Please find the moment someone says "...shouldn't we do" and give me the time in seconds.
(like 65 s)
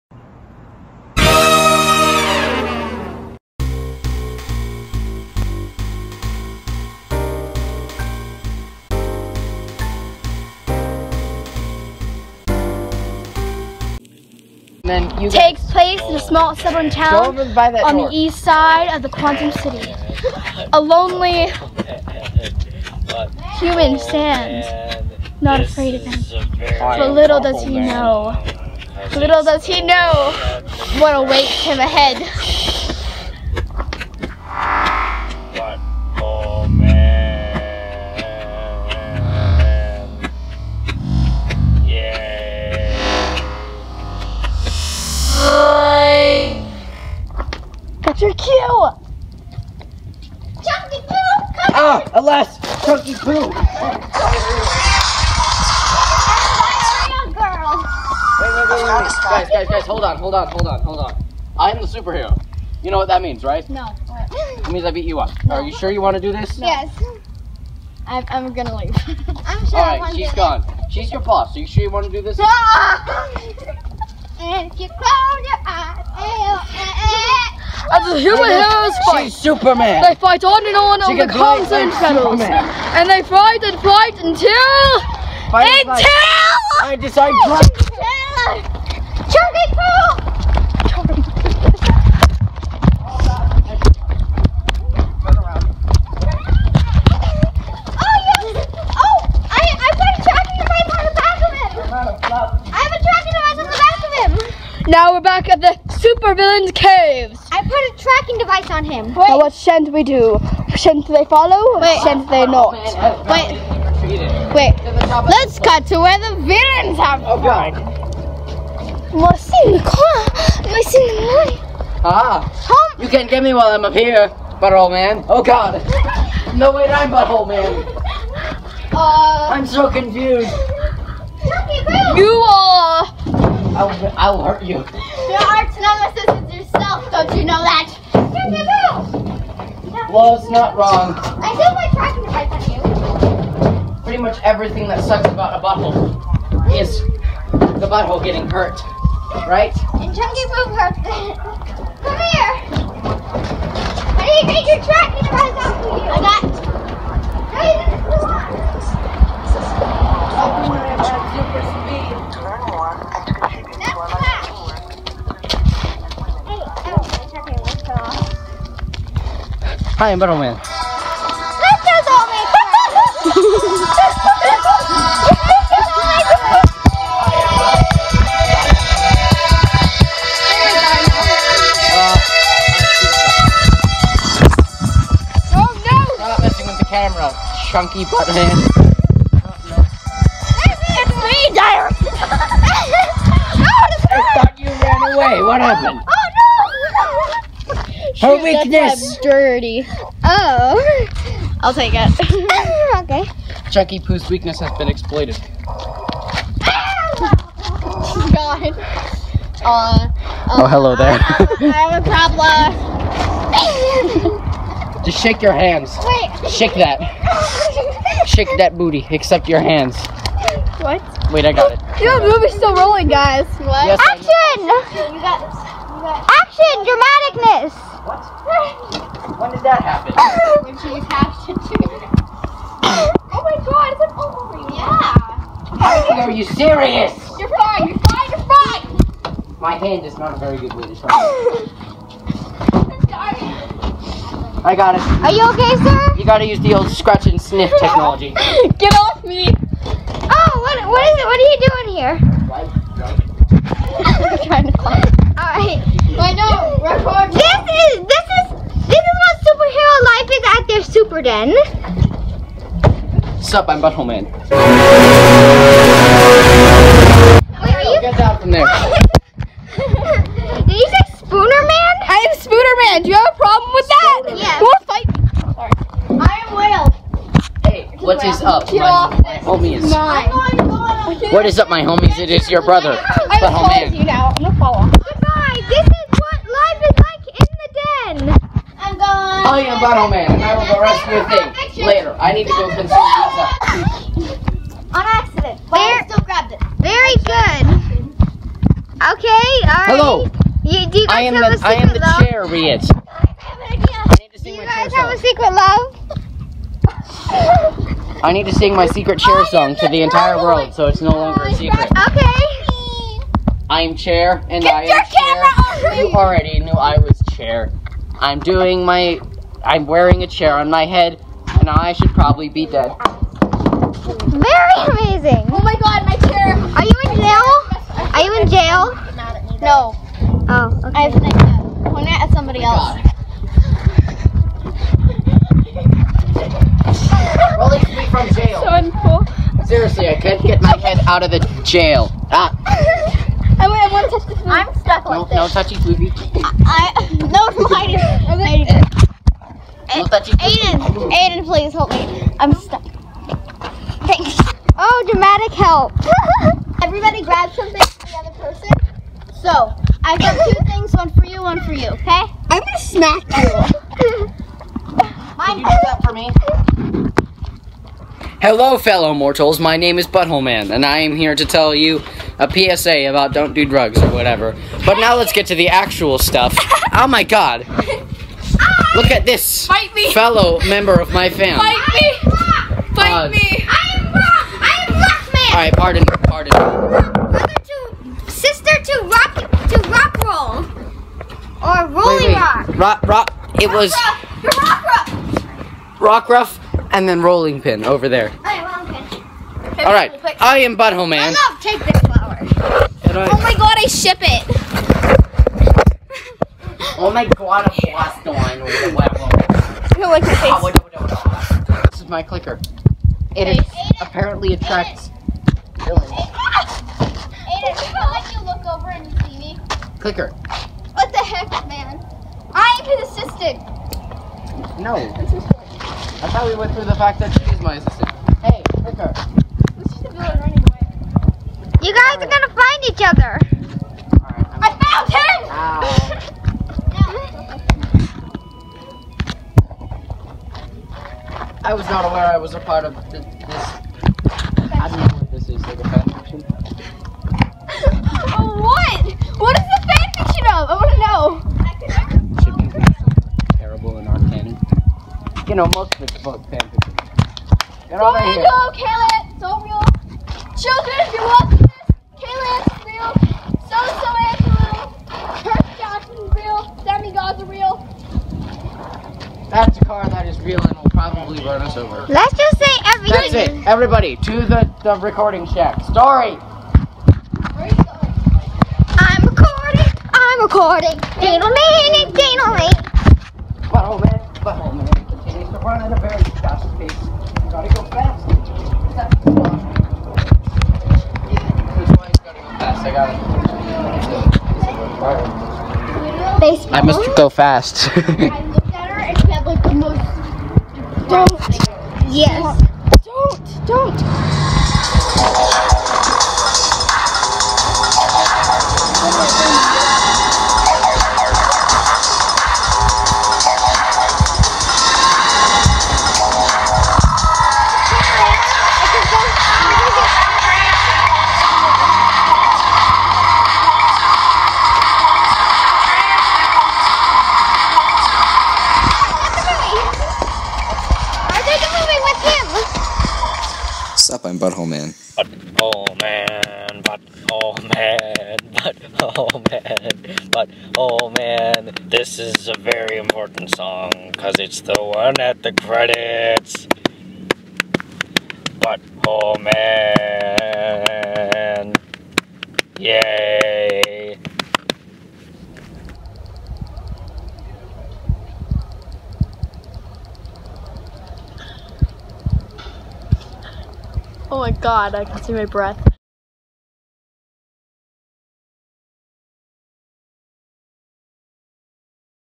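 109 s.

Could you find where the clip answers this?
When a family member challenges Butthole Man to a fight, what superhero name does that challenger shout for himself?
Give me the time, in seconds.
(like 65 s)
384 s.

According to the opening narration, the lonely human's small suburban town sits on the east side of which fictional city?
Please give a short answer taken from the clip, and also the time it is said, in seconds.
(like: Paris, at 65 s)
Quantum City, at 19 s.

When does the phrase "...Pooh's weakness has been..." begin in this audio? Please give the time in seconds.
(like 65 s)
203 s.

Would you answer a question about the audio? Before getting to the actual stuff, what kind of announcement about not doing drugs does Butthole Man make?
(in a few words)
PSA.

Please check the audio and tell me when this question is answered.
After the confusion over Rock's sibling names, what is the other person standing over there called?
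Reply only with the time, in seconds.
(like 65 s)
397 s.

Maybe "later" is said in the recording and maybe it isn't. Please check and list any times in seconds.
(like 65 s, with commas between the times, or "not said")
291 s.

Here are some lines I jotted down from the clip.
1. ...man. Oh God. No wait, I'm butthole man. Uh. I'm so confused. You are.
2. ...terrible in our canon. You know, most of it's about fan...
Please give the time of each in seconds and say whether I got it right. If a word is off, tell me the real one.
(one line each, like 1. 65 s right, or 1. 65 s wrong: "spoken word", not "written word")
1. 124 s right
2. 453 s right.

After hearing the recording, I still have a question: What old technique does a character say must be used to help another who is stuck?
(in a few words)
scratch and sniff.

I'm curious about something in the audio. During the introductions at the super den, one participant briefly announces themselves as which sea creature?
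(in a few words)
Whale.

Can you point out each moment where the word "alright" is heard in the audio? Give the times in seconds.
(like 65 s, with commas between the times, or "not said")
299 s, 385 s, 398 s.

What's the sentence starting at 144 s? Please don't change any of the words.
Pretty much everything that sucks about a butthole is the butthole getting hurt, right?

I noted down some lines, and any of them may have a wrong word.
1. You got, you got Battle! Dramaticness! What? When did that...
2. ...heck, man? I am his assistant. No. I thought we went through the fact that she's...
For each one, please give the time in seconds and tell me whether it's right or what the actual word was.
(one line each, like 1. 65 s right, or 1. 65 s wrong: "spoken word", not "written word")
1. 224 s wrong: "Action", not "Battle"
2. 421 s right.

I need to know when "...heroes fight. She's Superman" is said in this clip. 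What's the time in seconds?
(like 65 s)
78 s.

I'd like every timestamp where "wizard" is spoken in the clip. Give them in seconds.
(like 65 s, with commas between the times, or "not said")
not said.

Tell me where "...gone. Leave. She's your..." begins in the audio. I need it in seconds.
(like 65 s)
70 s.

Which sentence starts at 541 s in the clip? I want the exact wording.
This is a very important song because it's the one at the credits.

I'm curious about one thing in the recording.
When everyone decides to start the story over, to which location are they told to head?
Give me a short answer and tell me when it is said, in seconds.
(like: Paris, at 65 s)
the recording shack, at 474 s.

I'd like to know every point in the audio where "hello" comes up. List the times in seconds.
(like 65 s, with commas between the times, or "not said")
210 s, 299 s, 368 s.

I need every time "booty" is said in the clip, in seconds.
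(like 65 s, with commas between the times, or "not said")
218 s.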